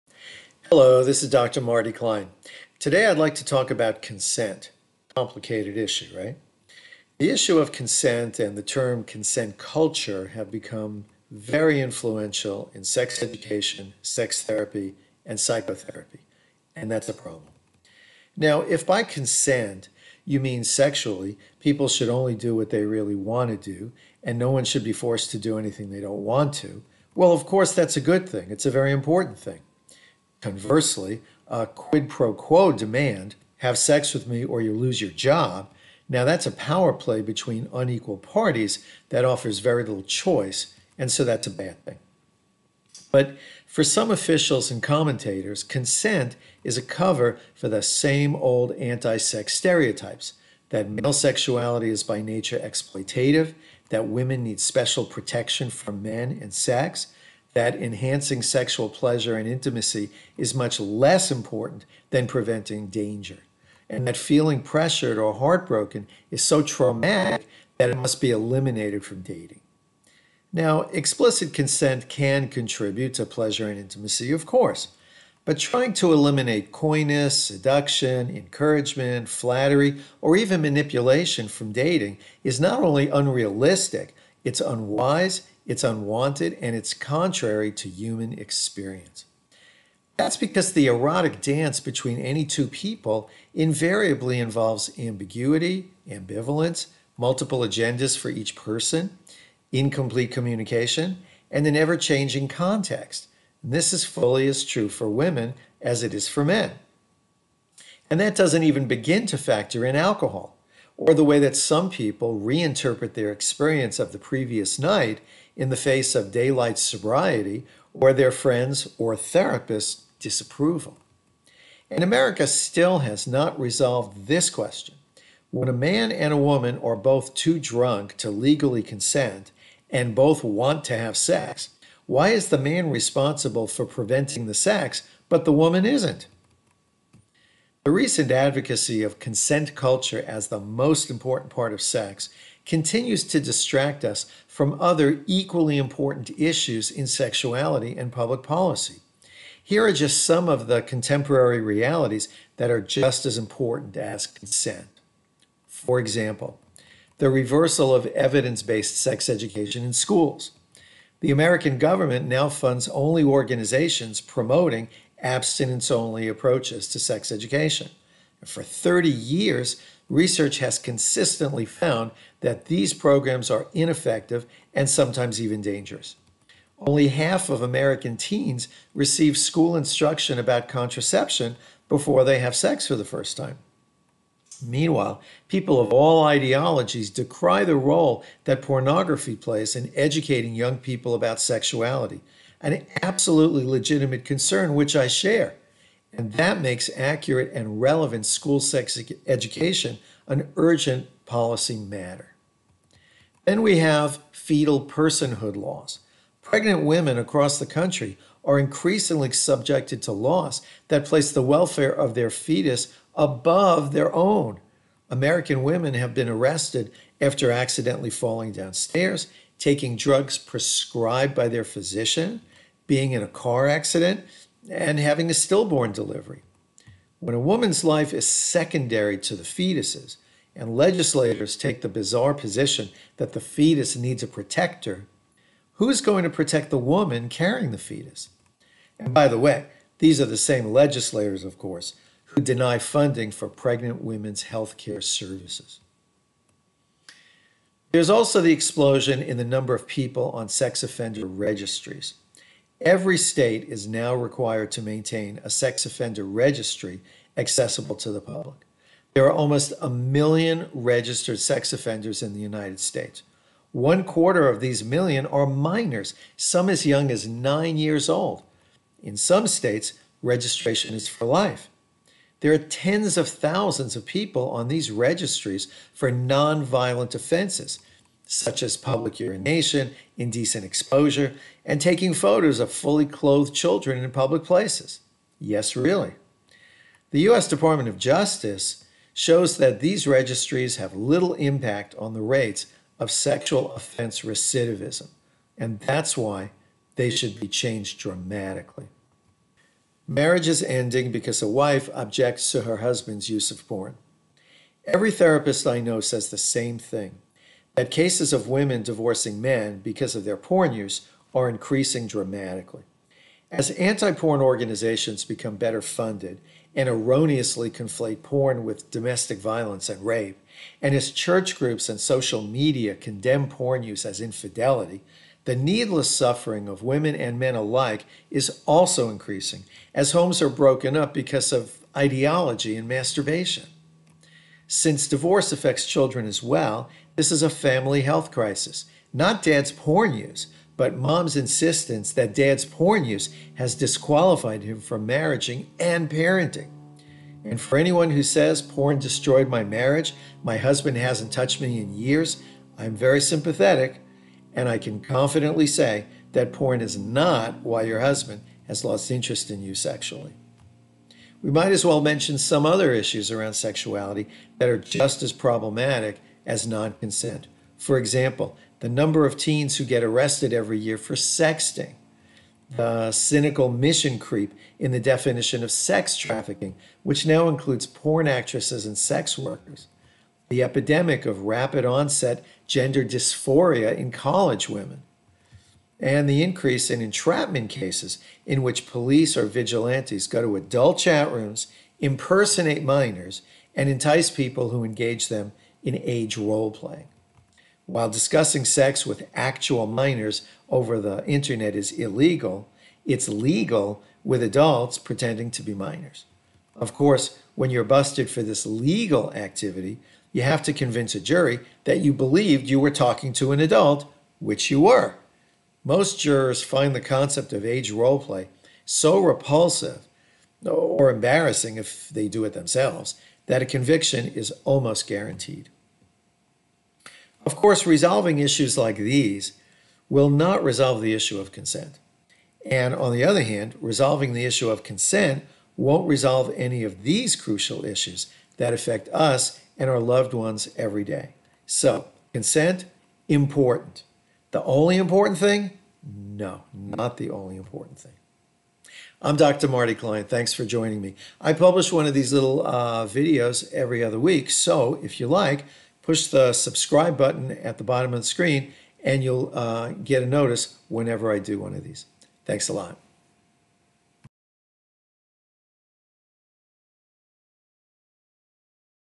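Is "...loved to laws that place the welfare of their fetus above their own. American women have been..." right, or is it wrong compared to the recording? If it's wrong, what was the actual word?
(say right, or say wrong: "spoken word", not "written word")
wrong: "subjected", not "loved".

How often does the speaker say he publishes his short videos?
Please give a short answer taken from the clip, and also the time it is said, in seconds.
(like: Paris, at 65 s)
Every other week, at 453 s.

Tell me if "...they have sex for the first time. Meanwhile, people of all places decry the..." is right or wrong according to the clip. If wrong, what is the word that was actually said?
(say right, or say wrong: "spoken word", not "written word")
wrong: "ideologies", not "places".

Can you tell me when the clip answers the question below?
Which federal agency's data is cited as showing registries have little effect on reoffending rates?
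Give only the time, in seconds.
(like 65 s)
287 s.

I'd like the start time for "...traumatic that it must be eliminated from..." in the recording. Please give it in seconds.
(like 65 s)
66 s.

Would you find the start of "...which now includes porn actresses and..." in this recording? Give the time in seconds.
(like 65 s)
377 s.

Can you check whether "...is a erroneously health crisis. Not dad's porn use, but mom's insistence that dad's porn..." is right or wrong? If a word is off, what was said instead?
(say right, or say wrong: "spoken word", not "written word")
wrong: "family", not "erroneously".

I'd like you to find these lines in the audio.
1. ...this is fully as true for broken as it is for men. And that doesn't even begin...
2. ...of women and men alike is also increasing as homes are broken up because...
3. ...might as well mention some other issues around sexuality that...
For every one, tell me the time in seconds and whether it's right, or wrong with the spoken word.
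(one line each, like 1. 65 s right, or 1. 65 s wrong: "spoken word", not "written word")
1. 103 s wrong: "women", not "broken"
2. 326 s right
3. 361 s right.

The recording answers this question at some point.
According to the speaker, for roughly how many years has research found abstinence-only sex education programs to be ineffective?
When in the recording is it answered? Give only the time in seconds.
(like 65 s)
168 s.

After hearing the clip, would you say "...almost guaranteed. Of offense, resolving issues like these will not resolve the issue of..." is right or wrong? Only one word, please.
wrong.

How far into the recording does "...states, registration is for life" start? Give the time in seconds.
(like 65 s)
269 s.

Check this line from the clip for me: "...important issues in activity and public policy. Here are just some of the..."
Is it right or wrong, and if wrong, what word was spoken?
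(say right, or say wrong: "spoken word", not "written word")
wrong: "sexuality", not "activity".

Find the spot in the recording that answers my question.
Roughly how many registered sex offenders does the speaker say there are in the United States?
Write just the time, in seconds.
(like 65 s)
259 s.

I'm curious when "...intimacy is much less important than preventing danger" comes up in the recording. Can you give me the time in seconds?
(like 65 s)
59 s.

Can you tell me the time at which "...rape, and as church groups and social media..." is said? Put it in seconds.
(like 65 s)
320 s.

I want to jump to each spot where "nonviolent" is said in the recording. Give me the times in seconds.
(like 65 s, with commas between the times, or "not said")
276 s.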